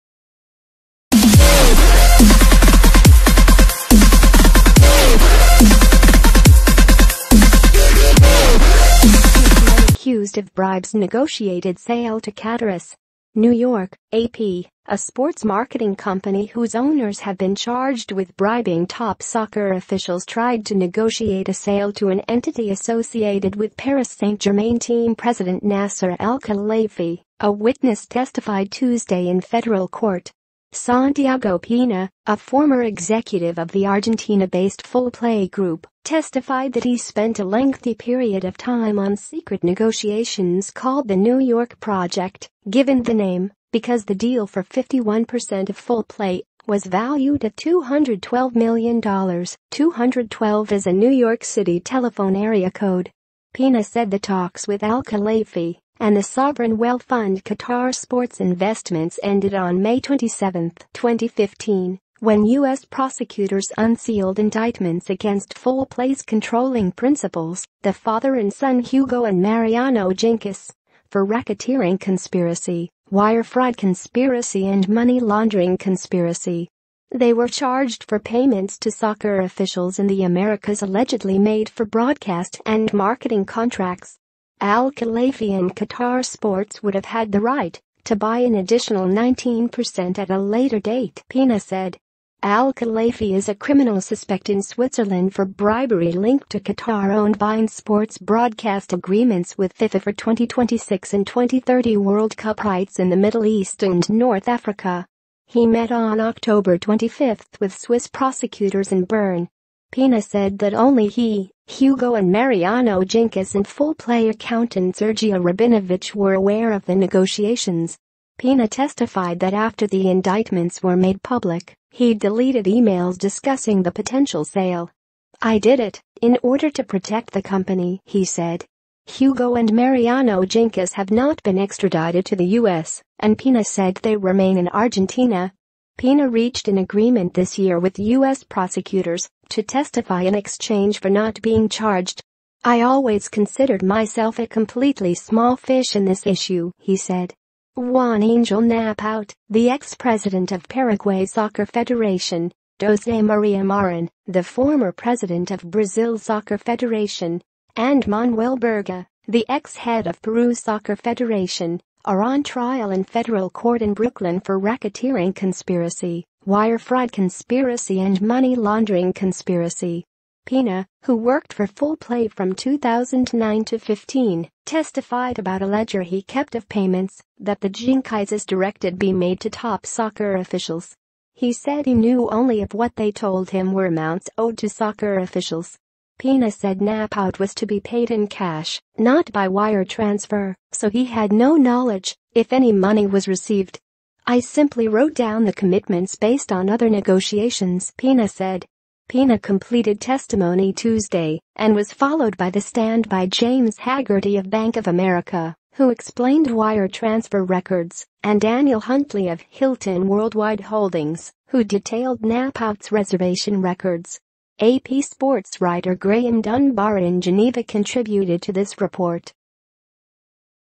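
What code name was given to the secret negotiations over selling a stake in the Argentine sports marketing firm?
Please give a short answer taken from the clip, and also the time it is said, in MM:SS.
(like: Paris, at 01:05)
New York Project, at 00:41.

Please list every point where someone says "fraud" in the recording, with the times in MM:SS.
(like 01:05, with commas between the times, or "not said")
01:13, 02:46.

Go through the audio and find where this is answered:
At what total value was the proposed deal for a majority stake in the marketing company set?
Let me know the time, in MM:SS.
00:47.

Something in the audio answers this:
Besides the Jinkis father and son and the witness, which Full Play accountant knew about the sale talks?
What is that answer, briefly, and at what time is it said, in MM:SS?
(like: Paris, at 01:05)
Sergio Rabinovich, at 01:54.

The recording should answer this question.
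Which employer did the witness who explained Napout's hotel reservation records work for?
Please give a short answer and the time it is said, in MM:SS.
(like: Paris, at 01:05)
Hilton Worldwide Holdings, at 03:29.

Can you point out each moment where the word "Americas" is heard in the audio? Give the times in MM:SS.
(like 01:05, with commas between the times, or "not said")
01:20, 03:24.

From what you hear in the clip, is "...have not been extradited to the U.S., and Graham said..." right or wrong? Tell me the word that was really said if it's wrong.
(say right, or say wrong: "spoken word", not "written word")
wrong: "Pena", not "Graham".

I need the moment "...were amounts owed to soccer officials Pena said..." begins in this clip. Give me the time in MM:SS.
03:03.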